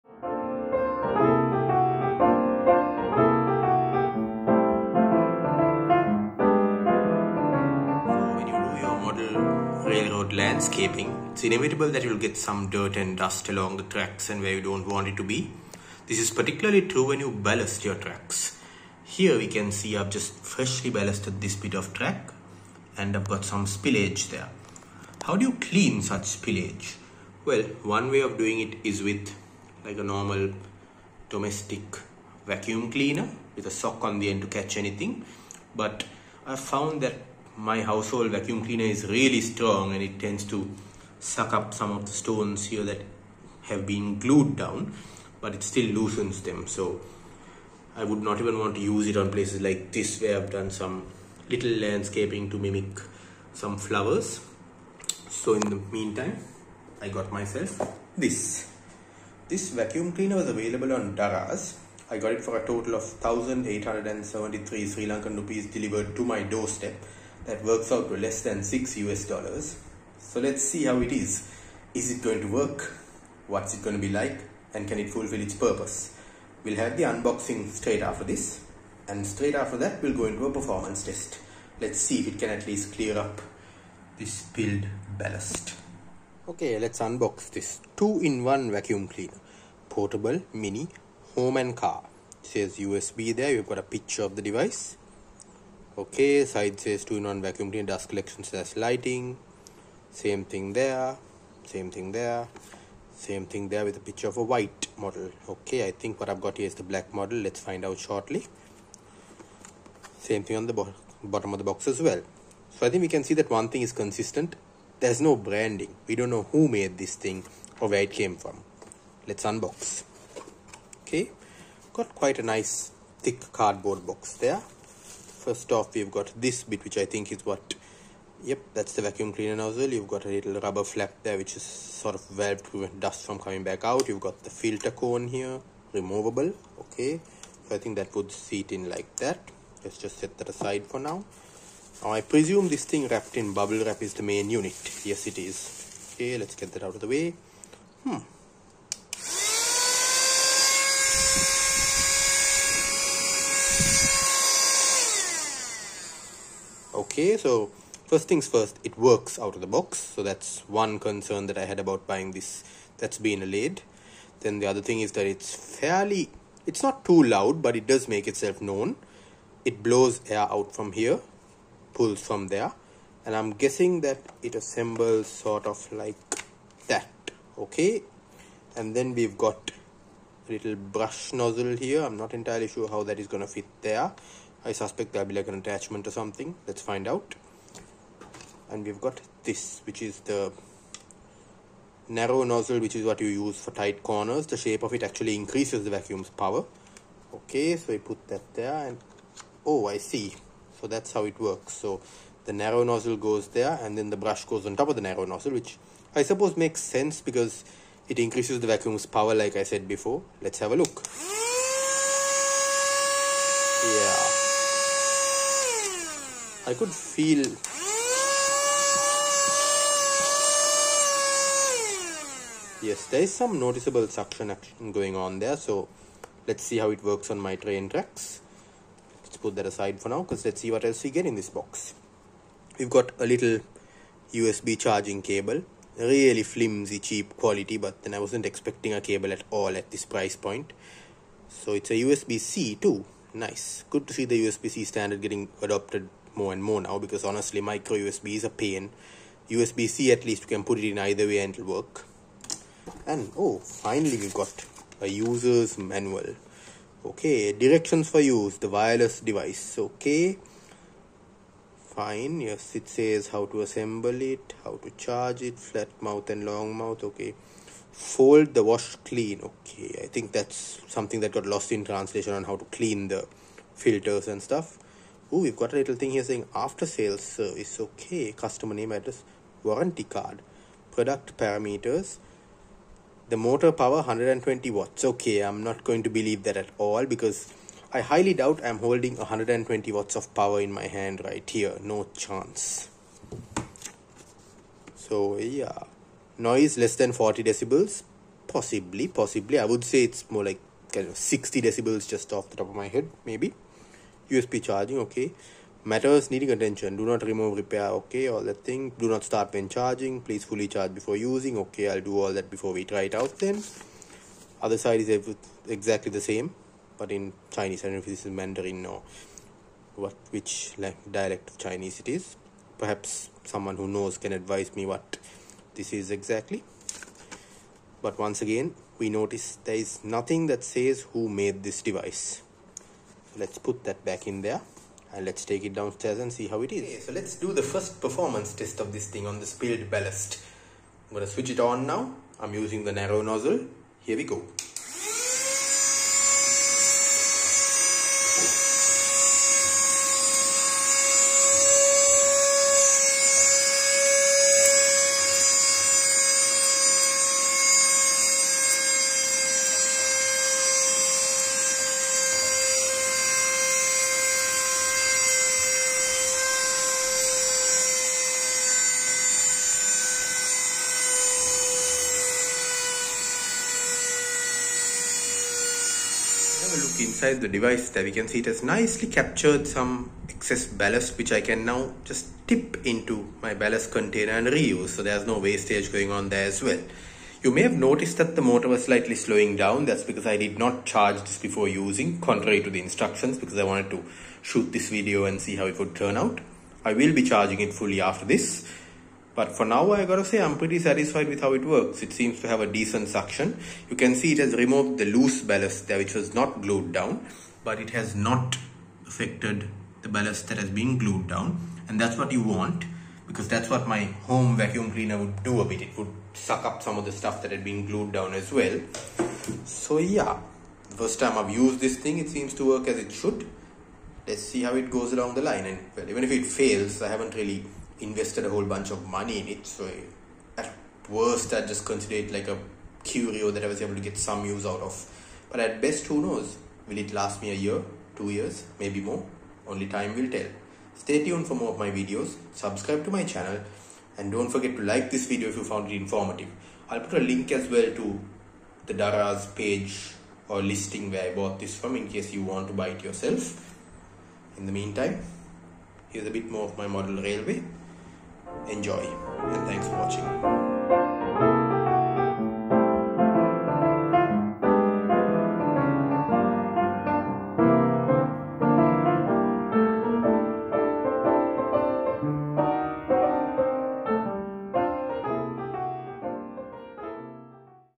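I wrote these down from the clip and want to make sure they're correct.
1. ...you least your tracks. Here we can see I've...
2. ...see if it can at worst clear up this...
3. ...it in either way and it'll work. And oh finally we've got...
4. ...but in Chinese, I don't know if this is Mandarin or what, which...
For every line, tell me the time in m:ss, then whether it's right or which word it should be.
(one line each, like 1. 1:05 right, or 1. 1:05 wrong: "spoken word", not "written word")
1. 0:17 wrong: "ballast", not "least"
2. 1:21 wrong: "least", not "worst"
3. 4:10 right
4. 5:16 right.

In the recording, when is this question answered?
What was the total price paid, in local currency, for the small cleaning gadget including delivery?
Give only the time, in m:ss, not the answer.
1:03.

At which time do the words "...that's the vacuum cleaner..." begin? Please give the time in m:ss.
2:08.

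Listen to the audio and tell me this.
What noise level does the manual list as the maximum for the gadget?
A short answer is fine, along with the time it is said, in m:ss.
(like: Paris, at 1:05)
40 decibels, at 4:57.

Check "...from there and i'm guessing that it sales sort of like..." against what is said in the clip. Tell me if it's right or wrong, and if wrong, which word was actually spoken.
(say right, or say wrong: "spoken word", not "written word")
wrong: "assembles", not "sales".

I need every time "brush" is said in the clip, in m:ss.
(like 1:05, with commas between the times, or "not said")
3:00, 3:24.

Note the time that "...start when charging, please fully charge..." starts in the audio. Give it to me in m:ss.
5:09.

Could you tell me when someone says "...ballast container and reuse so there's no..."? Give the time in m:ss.
6:23.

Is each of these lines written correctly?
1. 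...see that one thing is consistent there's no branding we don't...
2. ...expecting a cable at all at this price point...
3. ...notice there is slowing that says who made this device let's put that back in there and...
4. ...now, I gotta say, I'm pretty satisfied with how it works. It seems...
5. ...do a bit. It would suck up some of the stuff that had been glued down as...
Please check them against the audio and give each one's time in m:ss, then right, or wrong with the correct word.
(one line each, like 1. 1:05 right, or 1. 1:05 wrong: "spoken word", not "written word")
1. 1:53 right
2. 3:58 right
3. 5:29 wrong: "nothing", not "slowing"
4. 6:39 right
5. 6:55 right.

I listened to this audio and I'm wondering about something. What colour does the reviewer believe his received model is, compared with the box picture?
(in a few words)
Black.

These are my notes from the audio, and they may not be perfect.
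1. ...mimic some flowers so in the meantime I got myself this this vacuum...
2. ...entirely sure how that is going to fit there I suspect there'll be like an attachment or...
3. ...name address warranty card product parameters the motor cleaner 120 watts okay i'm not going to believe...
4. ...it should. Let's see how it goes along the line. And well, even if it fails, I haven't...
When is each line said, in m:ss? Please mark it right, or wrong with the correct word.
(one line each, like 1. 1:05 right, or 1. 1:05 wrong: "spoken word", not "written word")
1. 0:52 right
2. 3:02 right
3. 4:38 wrong: "power", not "cleaner"
4. 7:02 right.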